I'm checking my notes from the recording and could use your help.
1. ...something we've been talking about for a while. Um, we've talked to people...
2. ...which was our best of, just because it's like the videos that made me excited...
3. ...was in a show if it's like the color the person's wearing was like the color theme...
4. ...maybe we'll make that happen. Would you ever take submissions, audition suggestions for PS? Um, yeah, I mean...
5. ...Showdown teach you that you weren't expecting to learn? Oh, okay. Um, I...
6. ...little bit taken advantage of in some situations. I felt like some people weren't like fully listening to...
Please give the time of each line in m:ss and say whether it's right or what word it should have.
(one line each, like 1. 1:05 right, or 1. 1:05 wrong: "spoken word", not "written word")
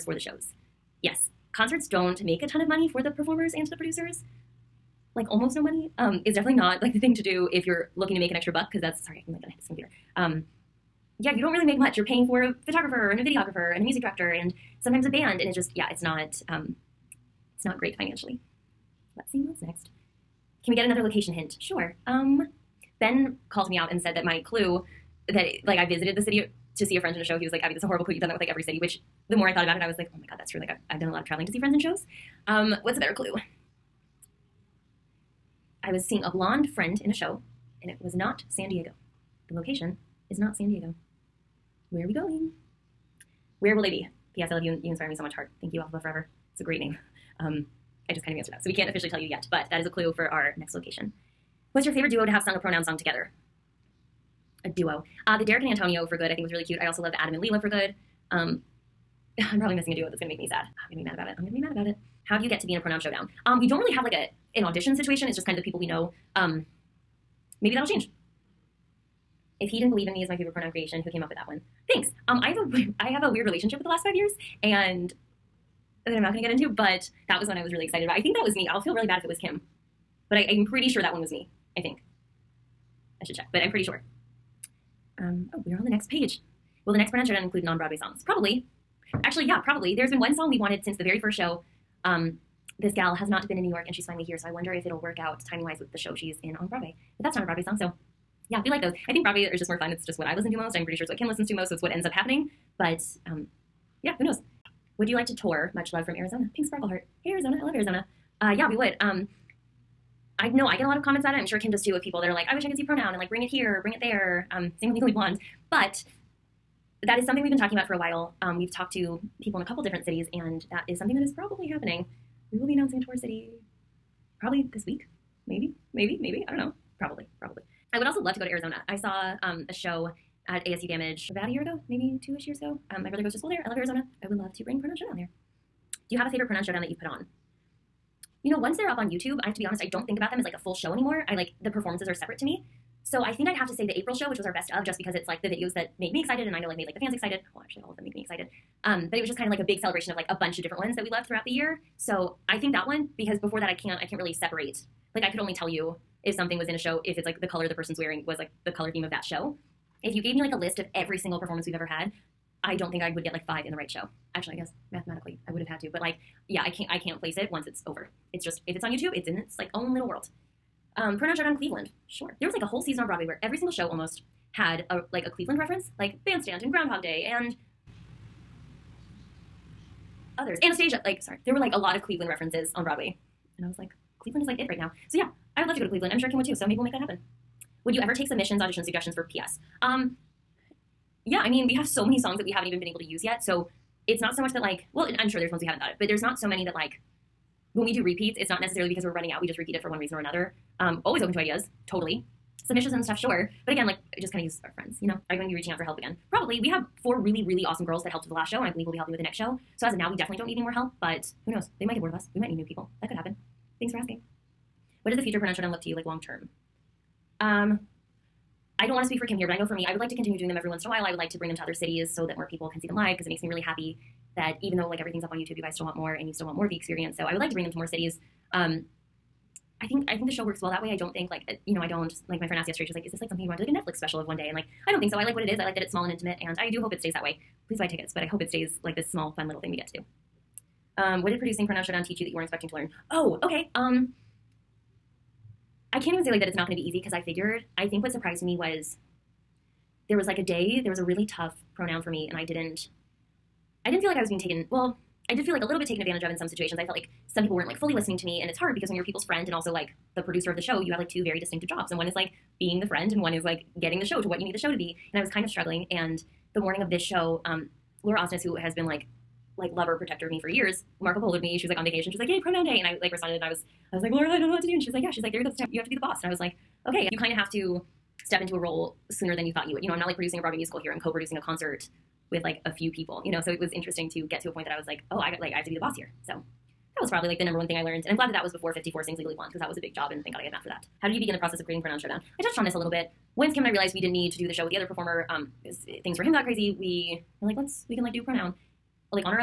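1. 1:57 right
2. 2:24 right
3. 2:36 right
4. 3:06 right
5. 4:01 right
6. 4:15 right.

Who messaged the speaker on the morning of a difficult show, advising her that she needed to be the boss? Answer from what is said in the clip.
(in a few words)
Laura Osnes.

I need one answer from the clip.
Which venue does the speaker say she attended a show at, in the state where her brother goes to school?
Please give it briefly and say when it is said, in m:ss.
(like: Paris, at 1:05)
ASU Gammage, at 2:10.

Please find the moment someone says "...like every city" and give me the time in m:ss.
0:28.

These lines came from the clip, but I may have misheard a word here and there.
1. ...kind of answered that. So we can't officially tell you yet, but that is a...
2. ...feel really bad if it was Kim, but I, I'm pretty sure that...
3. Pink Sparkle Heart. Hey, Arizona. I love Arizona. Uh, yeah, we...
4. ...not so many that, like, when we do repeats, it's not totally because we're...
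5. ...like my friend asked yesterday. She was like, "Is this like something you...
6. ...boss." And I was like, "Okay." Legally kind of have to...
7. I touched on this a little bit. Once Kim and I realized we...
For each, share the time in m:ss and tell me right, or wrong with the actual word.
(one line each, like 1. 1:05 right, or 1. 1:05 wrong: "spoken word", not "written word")
1. 0:48 right
2. 1:18 right
3. 1:46 right
4. 3:16 wrong: "necessarily", not "totally"
5. 3:52 right
6. 4:35 wrong: "You", not "Legally"
7. 4:52 right.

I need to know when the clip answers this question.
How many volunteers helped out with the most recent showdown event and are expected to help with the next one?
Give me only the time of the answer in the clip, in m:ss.
3:27.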